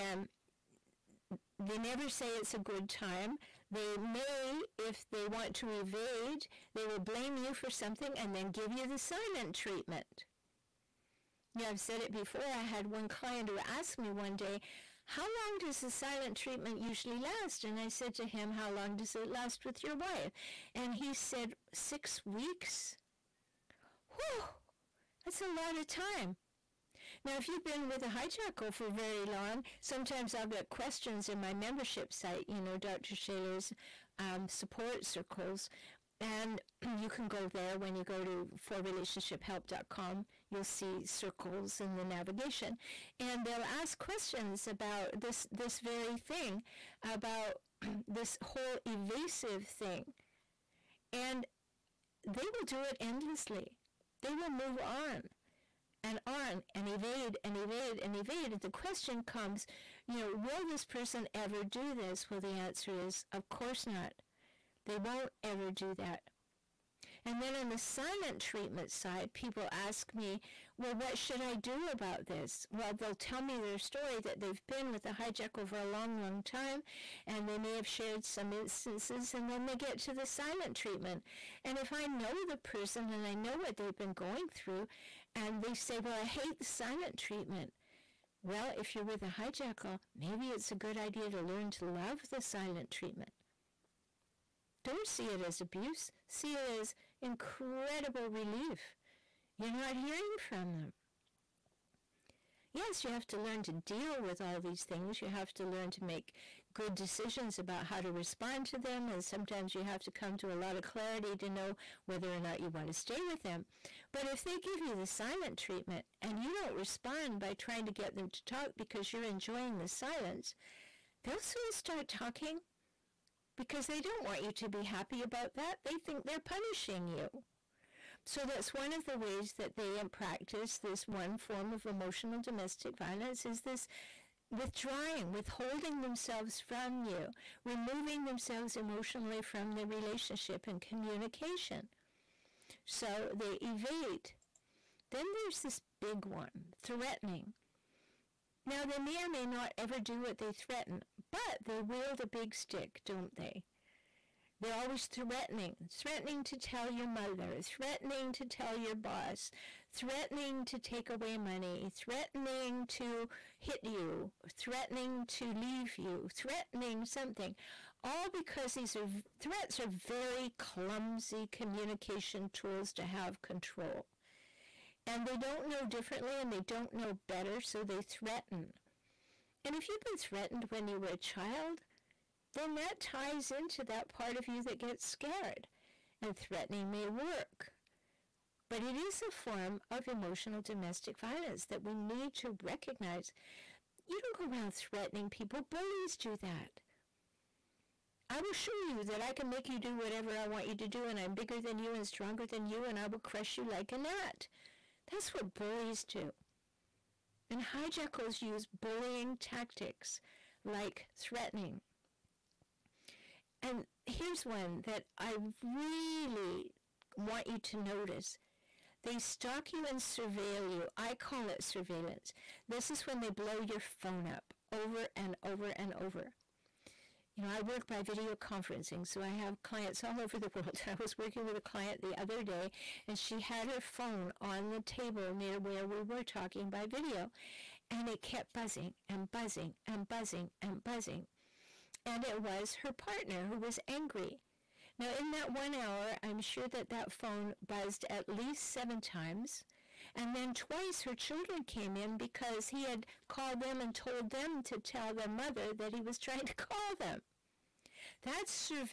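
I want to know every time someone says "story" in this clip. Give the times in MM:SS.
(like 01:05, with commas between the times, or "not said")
01:13.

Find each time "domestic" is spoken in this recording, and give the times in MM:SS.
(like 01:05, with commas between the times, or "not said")
02:12, 03:10.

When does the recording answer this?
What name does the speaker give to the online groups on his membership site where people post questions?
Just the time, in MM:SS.
00:34.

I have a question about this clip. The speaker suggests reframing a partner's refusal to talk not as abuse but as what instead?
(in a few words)
incredible relief.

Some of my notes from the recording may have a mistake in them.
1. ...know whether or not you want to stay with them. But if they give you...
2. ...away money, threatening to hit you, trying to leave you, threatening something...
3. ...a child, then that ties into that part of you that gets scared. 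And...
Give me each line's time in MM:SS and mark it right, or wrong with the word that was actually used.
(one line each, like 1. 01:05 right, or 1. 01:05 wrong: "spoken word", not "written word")
1. 01:51 right
2. 02:41 wrong: "threatening", not "trying"
3. 03:01 right.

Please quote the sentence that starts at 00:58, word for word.
And the question comes, you know, will this person ever do this?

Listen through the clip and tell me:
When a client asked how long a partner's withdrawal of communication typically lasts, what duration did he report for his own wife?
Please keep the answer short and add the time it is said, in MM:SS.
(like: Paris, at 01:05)
6 weeks, at 00:21.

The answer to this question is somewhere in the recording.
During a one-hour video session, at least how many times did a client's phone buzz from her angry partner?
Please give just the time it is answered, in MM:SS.
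04:08.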